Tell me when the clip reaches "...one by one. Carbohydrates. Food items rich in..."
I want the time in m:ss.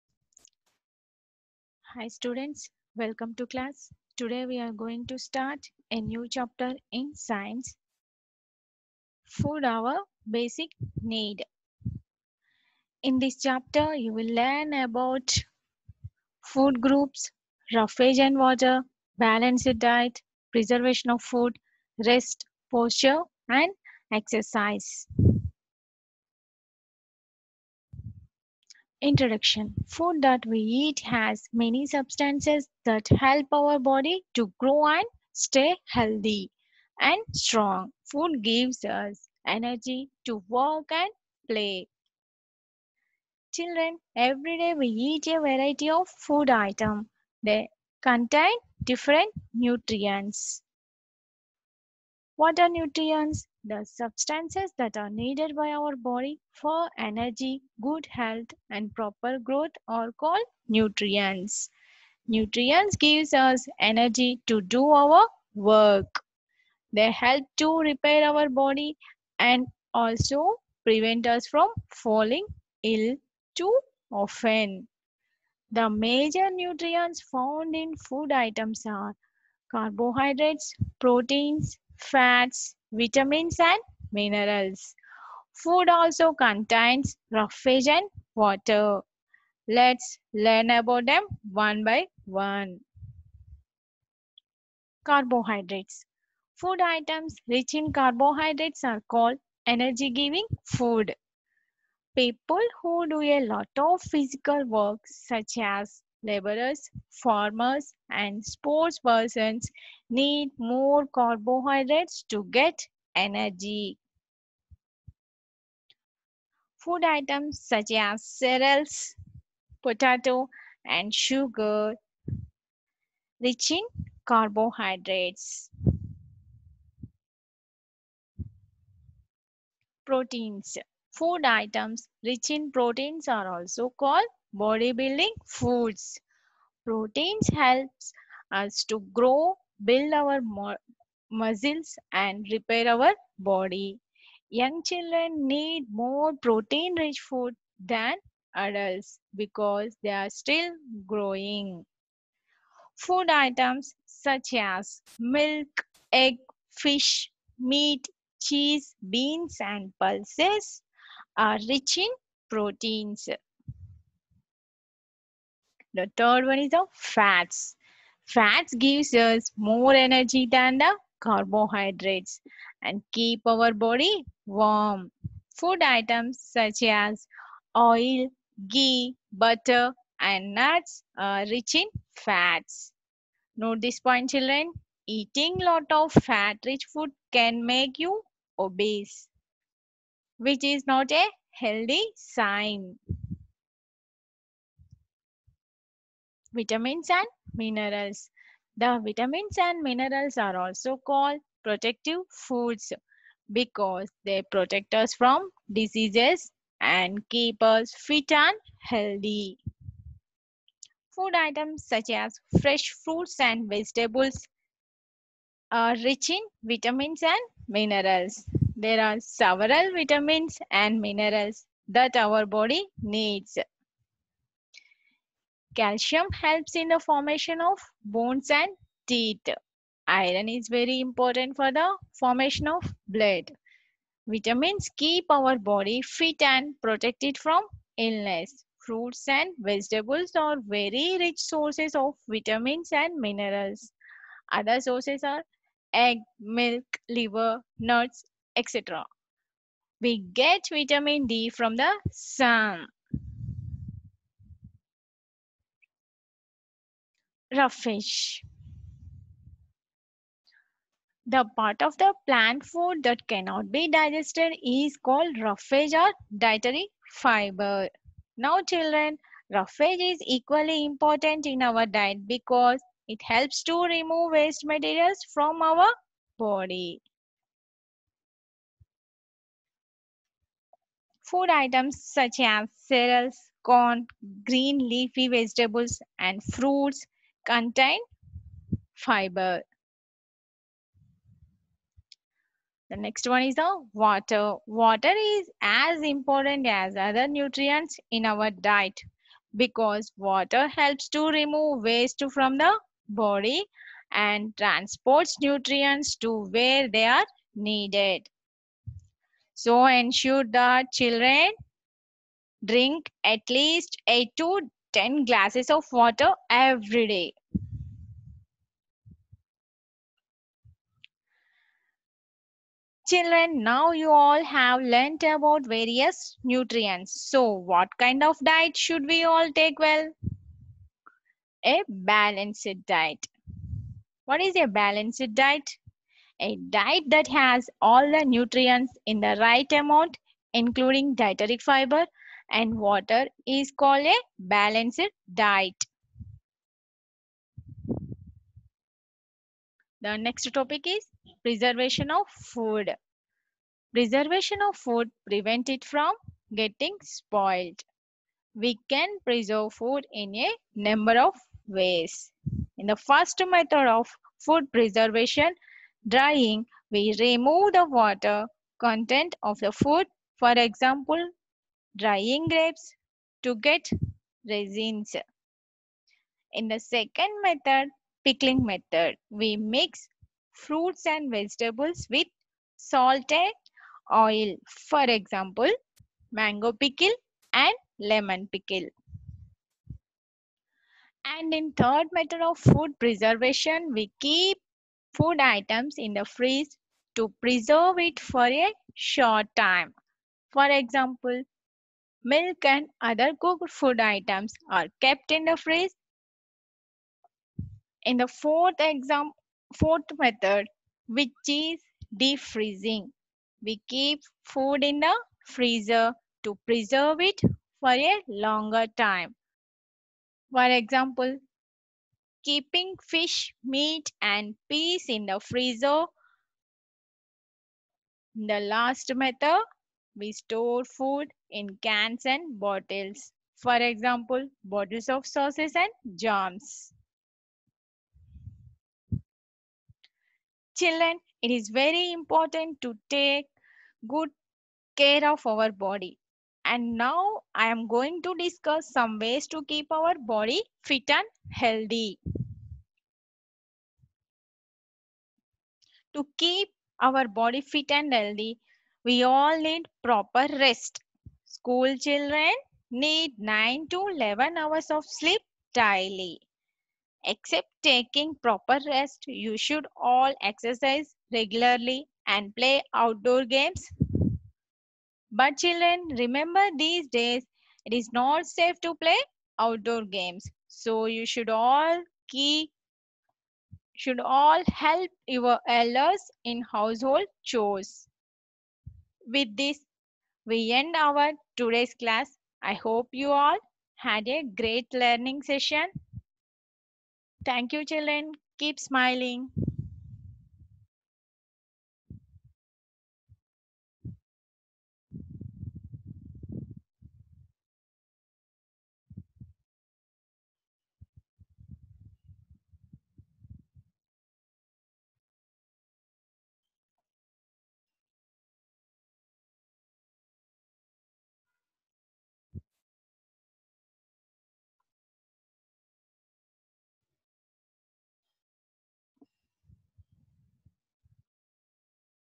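1:31.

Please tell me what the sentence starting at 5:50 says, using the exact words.
The next topic is preservation of food.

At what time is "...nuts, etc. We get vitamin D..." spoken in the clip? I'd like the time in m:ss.
4:07.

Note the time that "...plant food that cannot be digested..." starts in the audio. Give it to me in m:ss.
4:22.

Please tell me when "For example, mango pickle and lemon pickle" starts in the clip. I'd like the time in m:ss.
6:24.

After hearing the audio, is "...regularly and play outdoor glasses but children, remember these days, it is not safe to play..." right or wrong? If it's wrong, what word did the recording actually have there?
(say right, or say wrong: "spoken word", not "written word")
wrong: "games", not "glasses".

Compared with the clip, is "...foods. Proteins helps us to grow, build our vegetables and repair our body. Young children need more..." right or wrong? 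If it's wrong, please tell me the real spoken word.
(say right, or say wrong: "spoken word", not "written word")
wrong: "muscles", not "vegetables".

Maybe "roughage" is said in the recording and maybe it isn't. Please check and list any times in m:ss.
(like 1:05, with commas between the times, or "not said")
0:17, 1:27, 4:17, 4:25, 4:29.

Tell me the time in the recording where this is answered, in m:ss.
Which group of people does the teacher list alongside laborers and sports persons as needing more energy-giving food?
1:47.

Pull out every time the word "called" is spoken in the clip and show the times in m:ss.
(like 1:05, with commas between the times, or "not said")
1:00, 1:39, 2:13, 3:21, 4:24, 5:43.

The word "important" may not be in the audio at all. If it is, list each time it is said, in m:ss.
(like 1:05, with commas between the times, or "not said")
3:50, 4:30, 4:56, 7:22.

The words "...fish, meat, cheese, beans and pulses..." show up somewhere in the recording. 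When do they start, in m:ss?
2:36.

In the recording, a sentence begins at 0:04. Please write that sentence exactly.
Today we are going to start a new chapter in science.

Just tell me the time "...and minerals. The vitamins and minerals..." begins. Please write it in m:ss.
3:17.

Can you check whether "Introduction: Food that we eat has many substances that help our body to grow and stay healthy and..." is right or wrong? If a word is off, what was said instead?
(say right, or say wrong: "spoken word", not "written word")
right.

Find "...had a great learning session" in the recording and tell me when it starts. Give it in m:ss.
8:13.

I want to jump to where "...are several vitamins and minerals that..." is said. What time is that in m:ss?
3:39.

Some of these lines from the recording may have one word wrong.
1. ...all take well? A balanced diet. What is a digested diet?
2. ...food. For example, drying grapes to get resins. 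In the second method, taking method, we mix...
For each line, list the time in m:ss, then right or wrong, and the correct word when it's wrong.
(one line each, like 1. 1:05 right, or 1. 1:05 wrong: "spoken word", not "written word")
1. 5:29 wrong: "balanced", not "digested"
2. 6:09 wrong: "pickling", not "taking".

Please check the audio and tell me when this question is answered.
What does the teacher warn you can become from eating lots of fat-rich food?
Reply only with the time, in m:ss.
3:08.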